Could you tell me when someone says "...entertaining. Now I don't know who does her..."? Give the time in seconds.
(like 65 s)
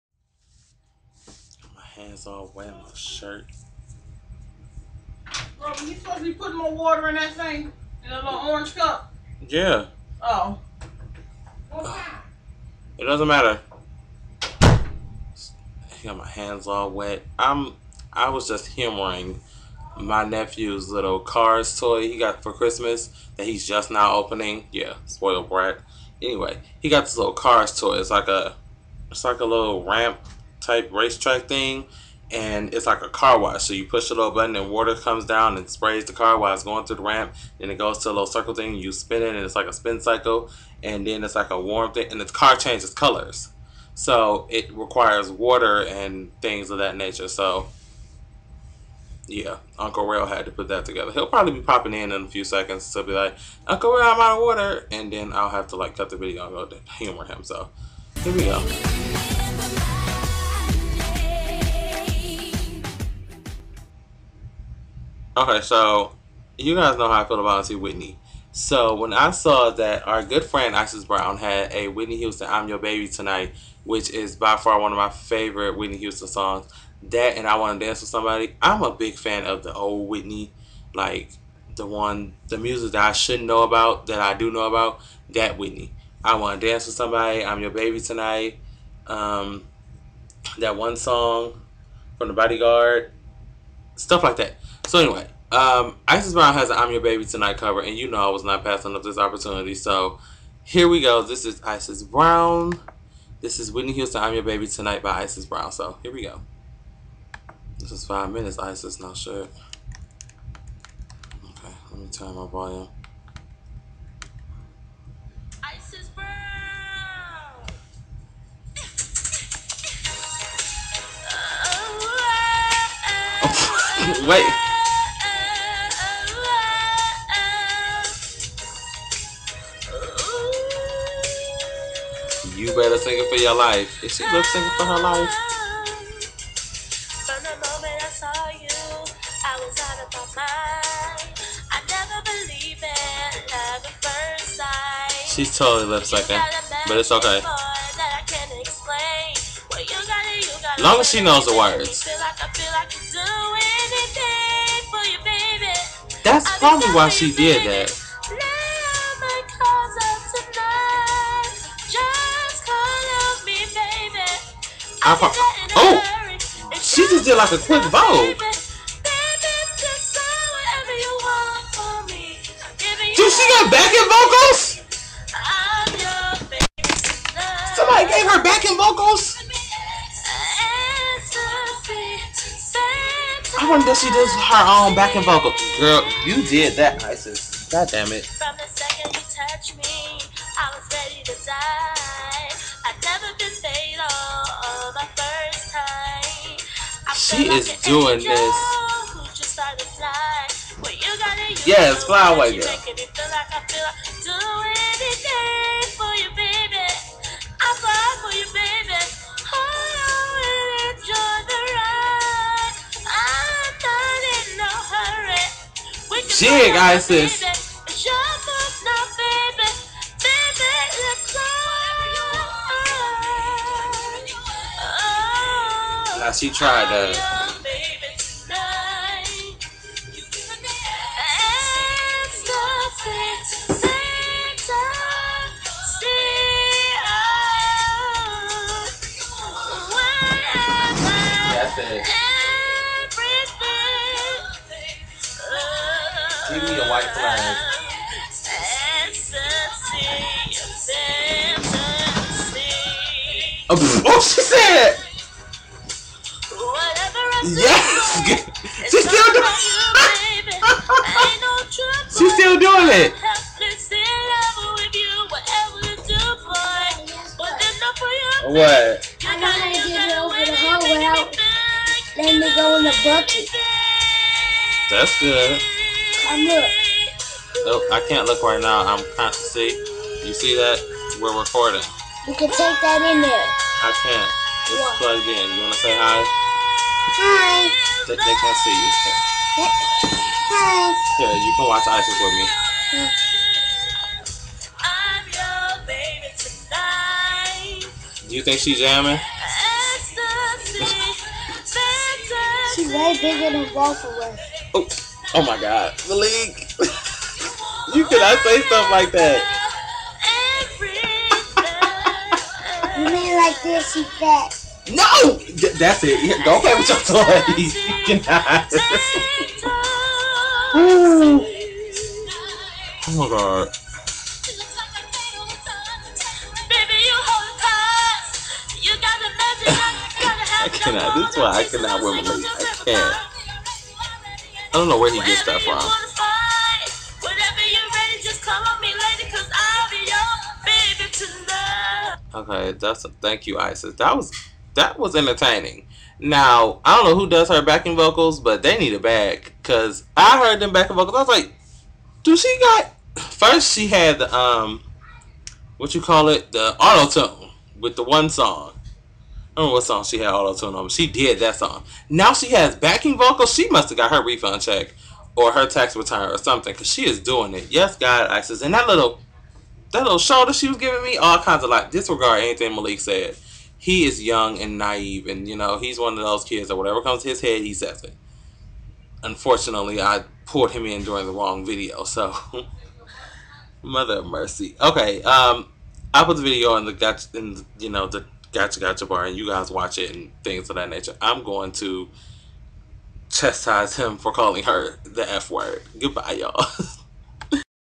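345 s.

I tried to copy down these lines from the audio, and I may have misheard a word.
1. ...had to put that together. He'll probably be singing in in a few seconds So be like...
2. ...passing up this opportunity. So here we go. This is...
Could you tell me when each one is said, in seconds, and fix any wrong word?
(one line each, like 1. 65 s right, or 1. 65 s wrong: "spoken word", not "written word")
1. 50 s wrong: "popping", not "singing"
2. 98 s right.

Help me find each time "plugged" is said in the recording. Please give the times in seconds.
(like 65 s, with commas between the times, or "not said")
284 s.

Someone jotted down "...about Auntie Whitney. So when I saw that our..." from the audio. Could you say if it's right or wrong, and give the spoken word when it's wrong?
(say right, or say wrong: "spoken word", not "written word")
right.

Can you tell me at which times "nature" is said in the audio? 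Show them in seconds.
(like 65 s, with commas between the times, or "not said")
46 s, 390 s.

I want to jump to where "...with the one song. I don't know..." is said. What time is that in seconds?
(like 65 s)
357 s.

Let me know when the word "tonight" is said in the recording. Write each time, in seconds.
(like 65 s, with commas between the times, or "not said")
73 s, 88 s, 97 s, 104 s.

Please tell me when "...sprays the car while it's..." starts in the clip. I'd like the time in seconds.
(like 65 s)
35 s.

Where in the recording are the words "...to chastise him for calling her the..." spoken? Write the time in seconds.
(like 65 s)
391 s.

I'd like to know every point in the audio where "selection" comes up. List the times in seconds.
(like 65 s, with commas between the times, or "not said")
not said.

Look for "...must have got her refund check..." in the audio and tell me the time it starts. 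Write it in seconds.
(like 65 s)
363 s.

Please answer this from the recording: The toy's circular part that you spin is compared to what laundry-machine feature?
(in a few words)
spin cycle.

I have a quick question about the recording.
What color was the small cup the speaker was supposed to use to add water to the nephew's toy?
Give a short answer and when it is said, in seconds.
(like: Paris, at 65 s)
orange, at 8 s.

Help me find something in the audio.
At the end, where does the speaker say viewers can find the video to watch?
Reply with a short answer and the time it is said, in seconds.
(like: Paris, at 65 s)
gotcha gotcha bar, at 388 s.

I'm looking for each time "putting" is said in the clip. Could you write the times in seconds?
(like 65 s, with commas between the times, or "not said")
6 s.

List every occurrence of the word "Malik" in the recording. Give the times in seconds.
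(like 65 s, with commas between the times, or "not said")
306 s, 372 s.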